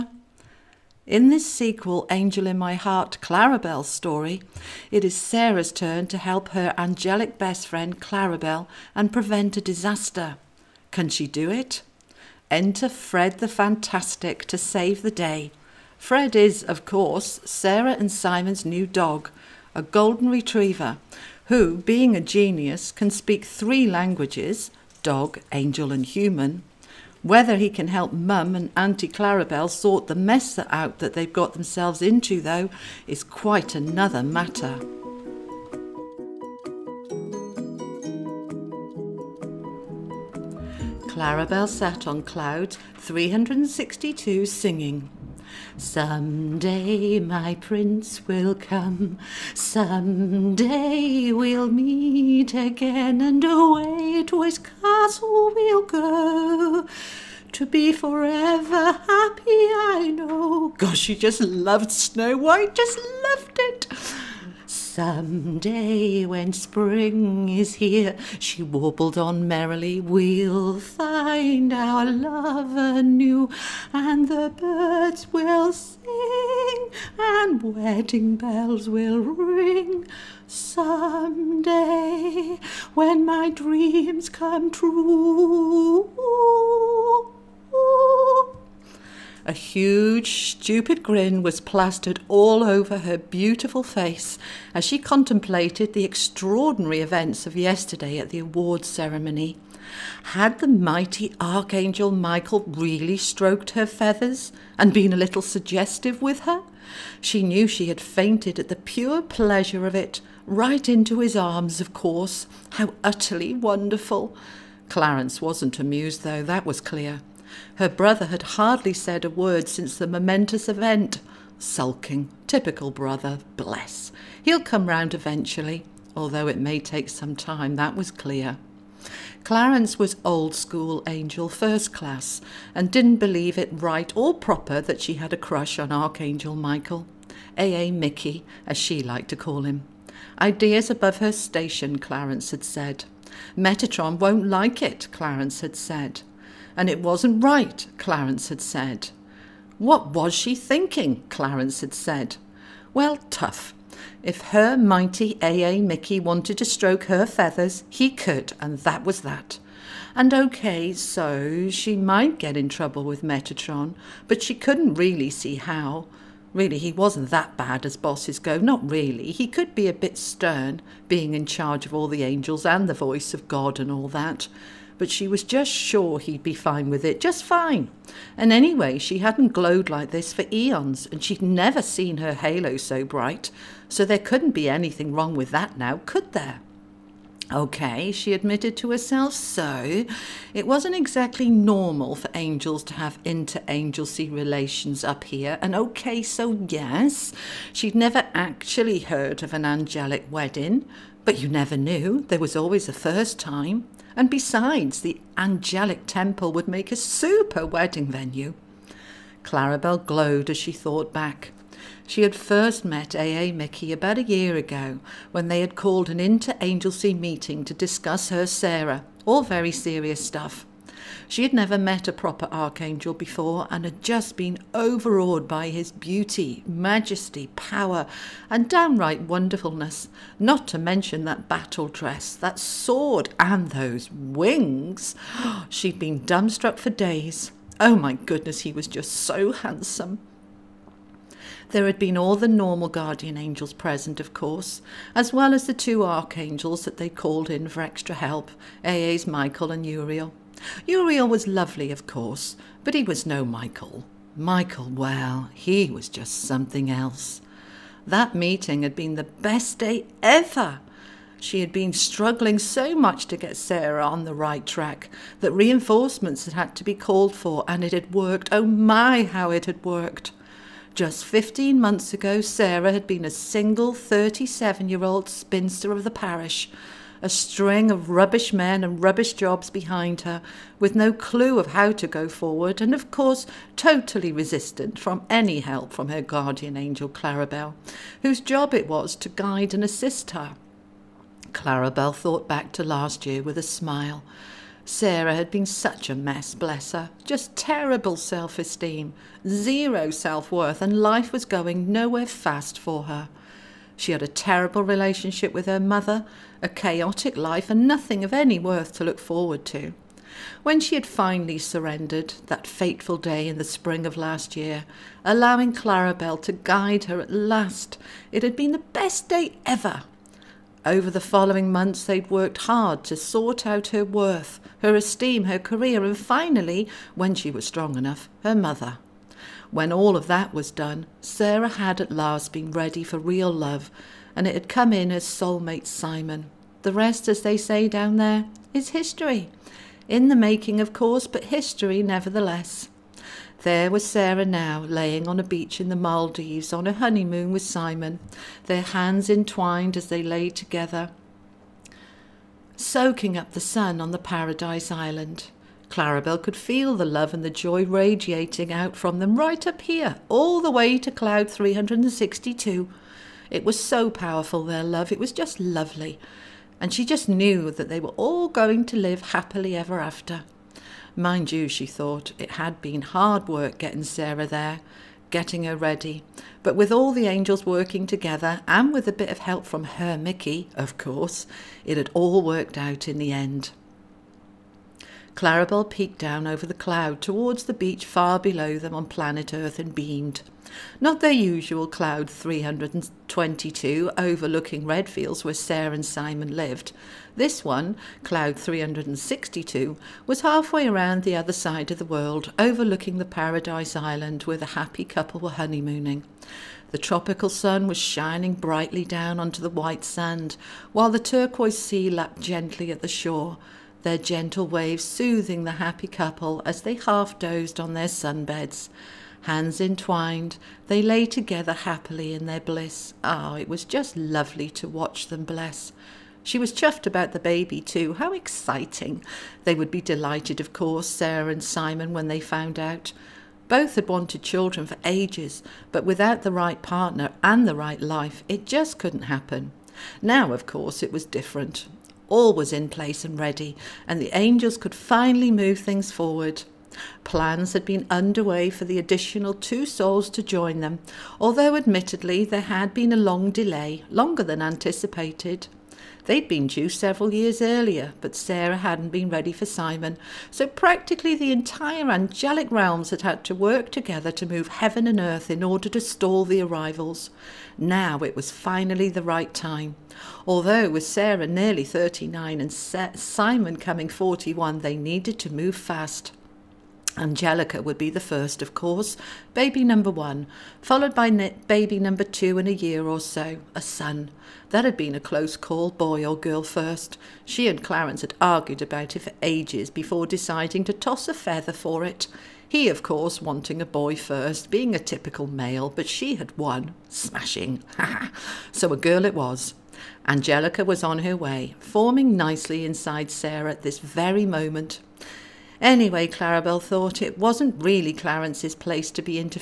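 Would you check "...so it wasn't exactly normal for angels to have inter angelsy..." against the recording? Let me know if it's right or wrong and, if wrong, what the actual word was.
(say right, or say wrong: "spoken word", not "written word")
right.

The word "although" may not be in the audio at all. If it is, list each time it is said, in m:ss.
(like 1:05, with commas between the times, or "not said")
2:06, 7:31, 7:50.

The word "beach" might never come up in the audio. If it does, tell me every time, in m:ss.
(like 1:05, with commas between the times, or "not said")
5:45, 6:27.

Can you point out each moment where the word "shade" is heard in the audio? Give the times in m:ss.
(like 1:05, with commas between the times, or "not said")
not said.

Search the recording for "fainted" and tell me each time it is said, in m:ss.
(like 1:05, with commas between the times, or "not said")
1:47.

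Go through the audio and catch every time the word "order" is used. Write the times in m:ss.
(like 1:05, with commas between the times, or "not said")
7:45.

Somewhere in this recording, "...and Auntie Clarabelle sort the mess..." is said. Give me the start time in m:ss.
0:28.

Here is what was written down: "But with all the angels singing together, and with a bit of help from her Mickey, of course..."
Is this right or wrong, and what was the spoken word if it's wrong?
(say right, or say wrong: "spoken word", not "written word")
wrong: "working", not "singing".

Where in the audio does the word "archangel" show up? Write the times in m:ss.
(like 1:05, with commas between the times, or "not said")
1:41, 2:15, 3:42, 4:06.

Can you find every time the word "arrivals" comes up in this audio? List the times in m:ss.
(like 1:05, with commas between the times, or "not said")
7:46.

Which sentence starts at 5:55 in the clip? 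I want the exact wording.
Clarabelle could feel the love and the joy radiating out from them right up here, all the way to cloud 362.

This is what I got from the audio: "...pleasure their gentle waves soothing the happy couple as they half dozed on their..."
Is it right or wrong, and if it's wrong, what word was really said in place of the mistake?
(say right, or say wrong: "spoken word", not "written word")
wrong: "shore", not "pleasure".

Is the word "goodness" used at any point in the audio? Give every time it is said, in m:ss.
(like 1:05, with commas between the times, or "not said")
3:58.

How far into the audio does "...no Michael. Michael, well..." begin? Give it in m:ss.
4:13.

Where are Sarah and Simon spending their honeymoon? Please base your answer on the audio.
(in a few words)
the Maldives.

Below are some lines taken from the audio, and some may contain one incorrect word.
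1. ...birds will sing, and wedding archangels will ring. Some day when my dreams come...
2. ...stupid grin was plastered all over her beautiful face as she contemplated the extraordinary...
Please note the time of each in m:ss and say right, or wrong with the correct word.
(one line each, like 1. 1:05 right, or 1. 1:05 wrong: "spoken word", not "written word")
1. 1:14 wrong: "bells", not "archangels"
2. 1:30 right.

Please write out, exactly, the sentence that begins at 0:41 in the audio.
Clarabelle sat on cloud 362 singing.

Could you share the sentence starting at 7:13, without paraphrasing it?
Both had wanted children for ages, but without the right partner and the right life, it just couldn't happen.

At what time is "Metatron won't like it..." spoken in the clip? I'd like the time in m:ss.
2:23.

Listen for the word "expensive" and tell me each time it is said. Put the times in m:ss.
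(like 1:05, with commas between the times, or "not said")
not said.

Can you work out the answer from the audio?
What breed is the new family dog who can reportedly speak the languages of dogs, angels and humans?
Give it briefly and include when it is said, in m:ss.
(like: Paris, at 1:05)
golden retriever, at 0:19.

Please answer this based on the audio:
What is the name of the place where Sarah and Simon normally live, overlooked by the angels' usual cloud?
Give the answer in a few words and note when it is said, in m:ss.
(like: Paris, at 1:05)
Redfields, at 6:34.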